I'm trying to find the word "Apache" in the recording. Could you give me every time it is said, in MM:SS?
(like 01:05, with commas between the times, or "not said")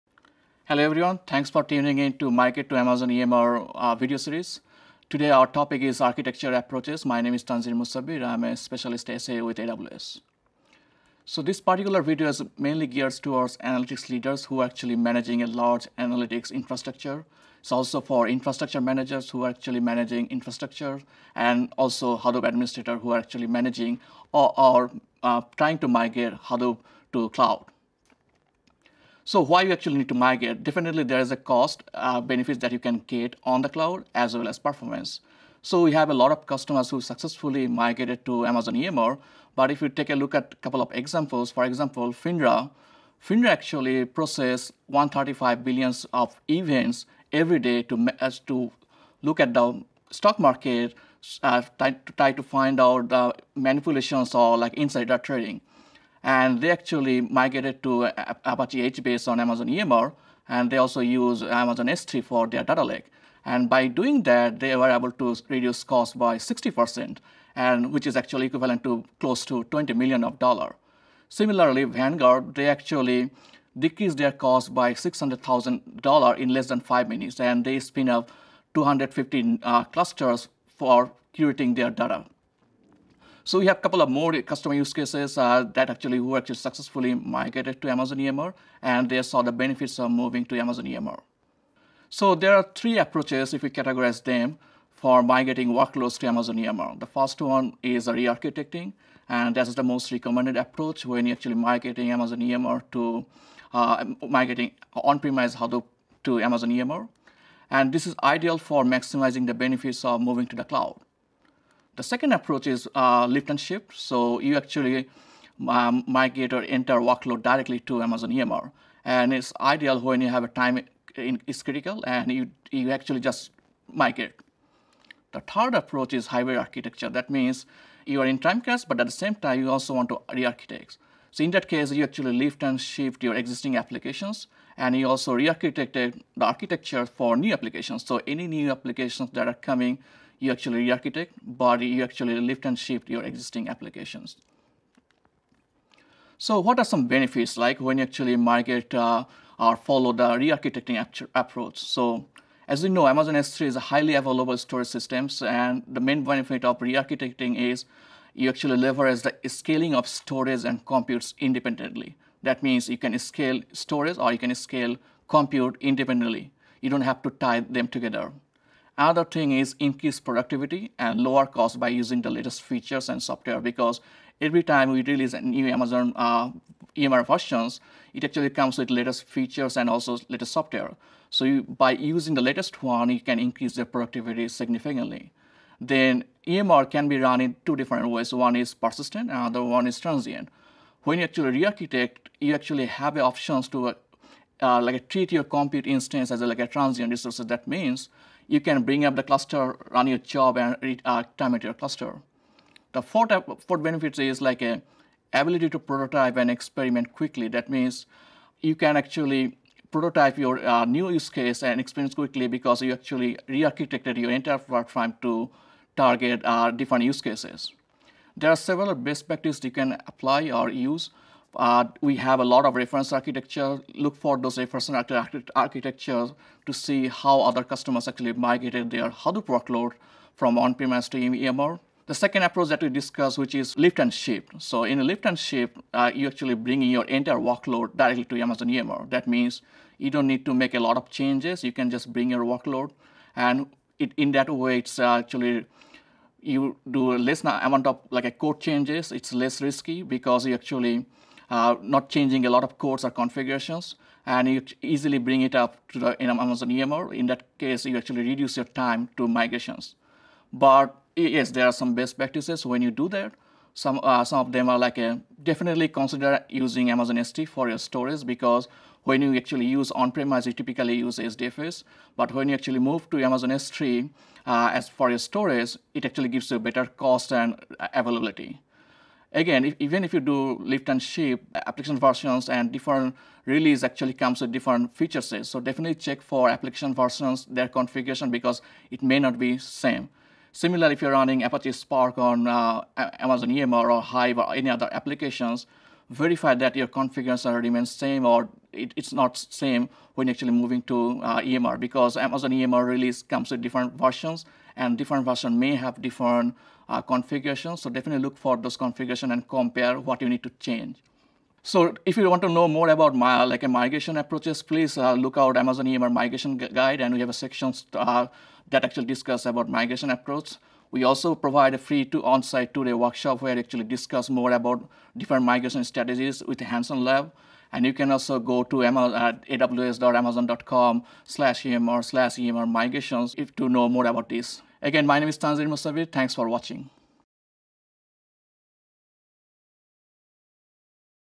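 00:58, 04:51.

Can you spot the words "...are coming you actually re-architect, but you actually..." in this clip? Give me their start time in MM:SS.
02:19.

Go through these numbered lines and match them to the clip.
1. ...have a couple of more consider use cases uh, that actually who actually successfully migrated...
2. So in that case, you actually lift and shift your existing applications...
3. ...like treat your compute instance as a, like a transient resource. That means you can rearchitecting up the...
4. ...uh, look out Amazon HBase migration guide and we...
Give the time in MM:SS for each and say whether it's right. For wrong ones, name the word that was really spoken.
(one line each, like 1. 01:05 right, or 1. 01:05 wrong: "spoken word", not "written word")
1. 01:23 wrong: "customer", not "consider"
2. 02:11 right
3. 03:14 wrong: "bring", not "rearchitecting"
4. 05:14 wrong: "EMR", not "HBase".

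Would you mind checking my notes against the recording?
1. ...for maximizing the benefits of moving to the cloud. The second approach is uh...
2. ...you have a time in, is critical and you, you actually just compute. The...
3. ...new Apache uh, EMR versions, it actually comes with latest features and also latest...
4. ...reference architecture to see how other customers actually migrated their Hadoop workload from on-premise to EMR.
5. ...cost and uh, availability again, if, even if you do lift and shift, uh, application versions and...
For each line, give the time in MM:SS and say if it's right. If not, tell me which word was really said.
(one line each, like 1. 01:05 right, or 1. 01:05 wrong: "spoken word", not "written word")
1. 01:48 right
2. 02:00 wrong: "migrate", not "compute"
3. 02:55 wrong: "Amazon", not "Apache"
4. 03:44 right
5. 04:36 right.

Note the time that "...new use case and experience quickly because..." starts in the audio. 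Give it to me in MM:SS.
03:30.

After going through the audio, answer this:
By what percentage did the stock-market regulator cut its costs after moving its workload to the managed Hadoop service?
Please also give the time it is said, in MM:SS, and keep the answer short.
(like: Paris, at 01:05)
60%, at 01:06.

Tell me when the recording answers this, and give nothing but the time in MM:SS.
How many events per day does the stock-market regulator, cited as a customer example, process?
00:44.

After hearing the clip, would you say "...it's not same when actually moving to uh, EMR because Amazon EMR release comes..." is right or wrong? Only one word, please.
right.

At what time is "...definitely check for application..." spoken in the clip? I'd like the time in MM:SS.
04:45.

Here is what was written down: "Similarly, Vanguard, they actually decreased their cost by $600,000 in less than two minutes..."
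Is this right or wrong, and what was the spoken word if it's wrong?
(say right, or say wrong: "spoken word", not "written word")
wrong: "five", not "two".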